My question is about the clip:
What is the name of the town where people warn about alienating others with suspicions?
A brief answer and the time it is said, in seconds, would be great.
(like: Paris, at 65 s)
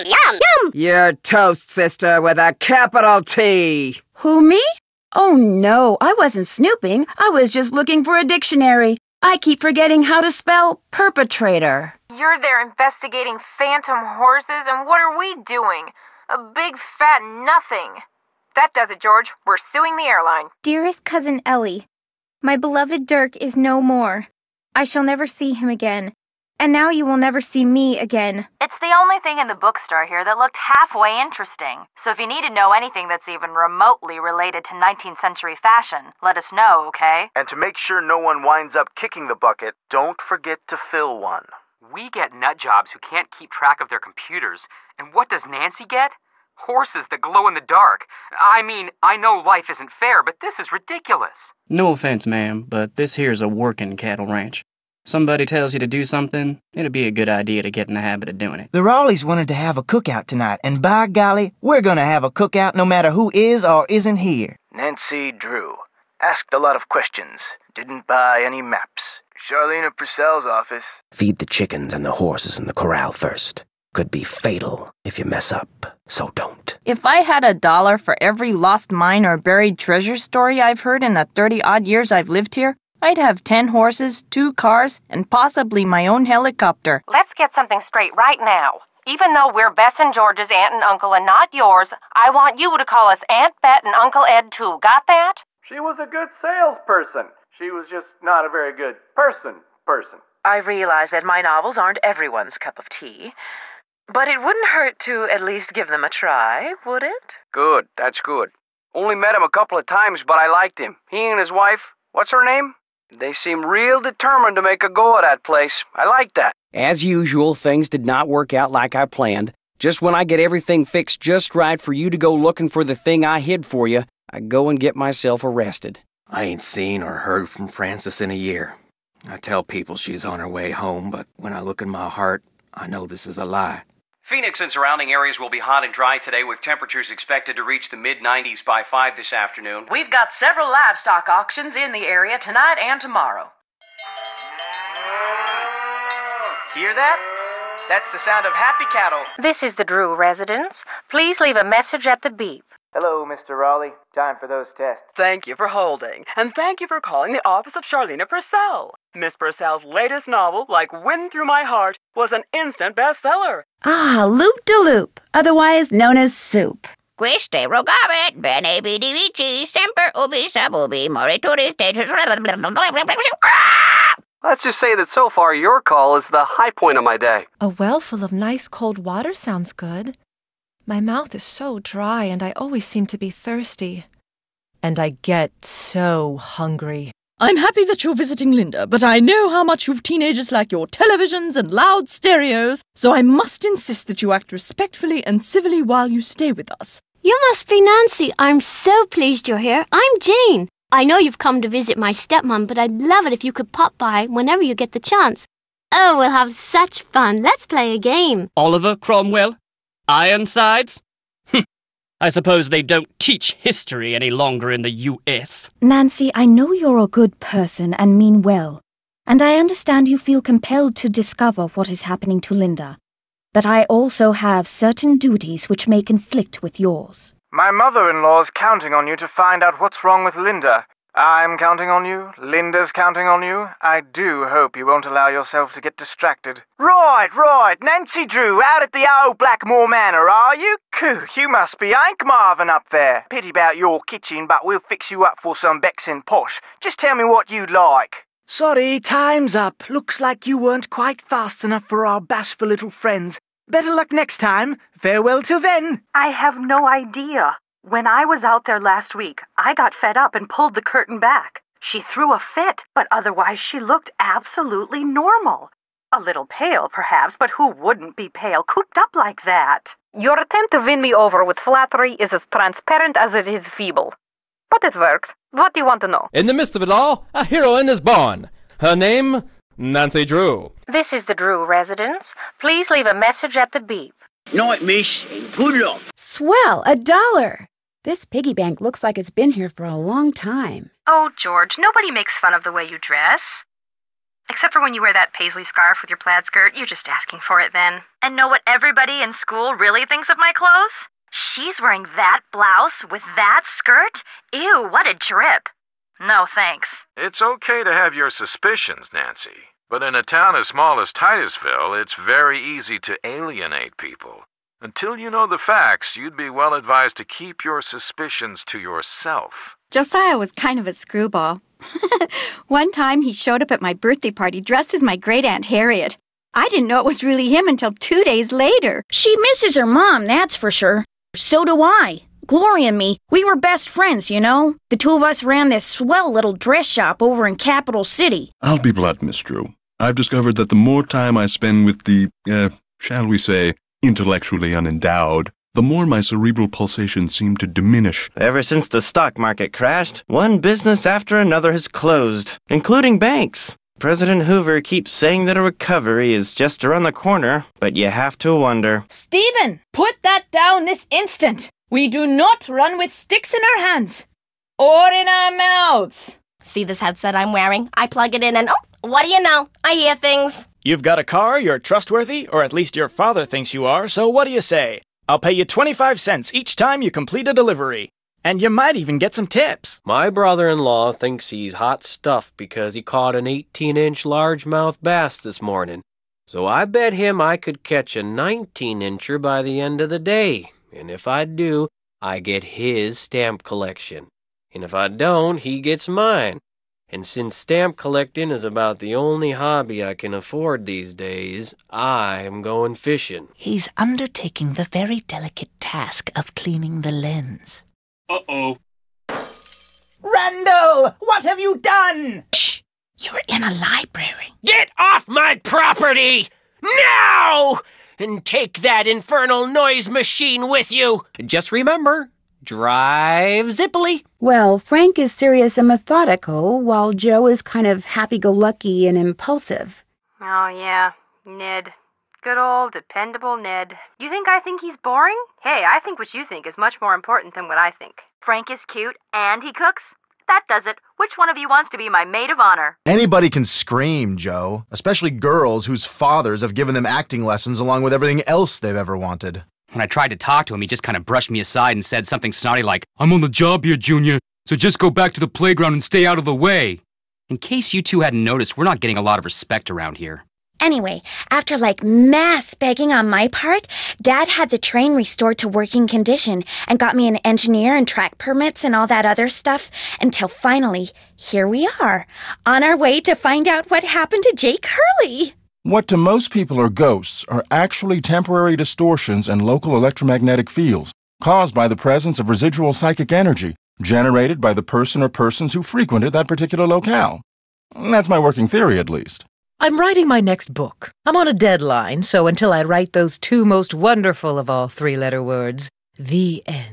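Titusville, at 311 s.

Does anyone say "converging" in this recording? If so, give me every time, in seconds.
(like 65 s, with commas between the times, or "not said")
not said.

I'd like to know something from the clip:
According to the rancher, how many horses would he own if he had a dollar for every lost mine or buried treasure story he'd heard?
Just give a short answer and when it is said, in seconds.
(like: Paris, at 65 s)
10, at 83 s.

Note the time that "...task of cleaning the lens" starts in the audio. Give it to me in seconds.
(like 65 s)
405 s.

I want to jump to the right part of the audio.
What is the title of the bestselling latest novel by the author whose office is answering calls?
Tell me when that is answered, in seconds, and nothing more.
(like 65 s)
160 s.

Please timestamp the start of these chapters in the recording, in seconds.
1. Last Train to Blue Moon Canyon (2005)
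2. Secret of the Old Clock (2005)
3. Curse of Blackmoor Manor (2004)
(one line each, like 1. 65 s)
1. 424 s
2. 285 s
3. 163 s.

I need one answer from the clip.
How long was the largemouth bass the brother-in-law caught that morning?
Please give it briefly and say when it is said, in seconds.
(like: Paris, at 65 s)
18 inch, at 383 s.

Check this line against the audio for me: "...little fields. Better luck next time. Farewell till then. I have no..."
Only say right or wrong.
wrong.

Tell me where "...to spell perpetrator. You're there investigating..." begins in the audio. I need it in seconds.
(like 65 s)
10 s.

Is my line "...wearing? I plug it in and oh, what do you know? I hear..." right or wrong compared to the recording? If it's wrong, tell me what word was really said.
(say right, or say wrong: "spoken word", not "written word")
right.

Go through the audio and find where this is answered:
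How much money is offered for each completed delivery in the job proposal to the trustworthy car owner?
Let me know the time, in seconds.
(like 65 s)
375 s.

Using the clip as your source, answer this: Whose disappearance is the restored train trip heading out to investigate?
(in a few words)
Jake Hurley.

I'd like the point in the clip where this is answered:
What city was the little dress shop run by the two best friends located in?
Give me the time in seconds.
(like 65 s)
337 s.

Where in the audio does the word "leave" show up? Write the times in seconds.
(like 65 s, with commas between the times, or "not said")
151 s, 282 s.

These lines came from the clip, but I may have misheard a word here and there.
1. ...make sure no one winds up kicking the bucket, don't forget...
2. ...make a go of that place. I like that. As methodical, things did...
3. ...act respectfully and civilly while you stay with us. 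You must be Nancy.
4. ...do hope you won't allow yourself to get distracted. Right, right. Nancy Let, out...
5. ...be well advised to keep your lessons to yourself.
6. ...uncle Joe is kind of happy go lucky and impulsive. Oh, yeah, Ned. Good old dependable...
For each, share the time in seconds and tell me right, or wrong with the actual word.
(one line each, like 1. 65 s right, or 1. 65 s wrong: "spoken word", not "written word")
1. 37 s right
2. 114 s wrong: "usual", not "methodical"
3. 194 s right
4. 233 s wrong: "Drew", not "Let"
5. 316 s wrong: "suspicions", not "lessons"
6. 426 s wrong: "while", not "uncle".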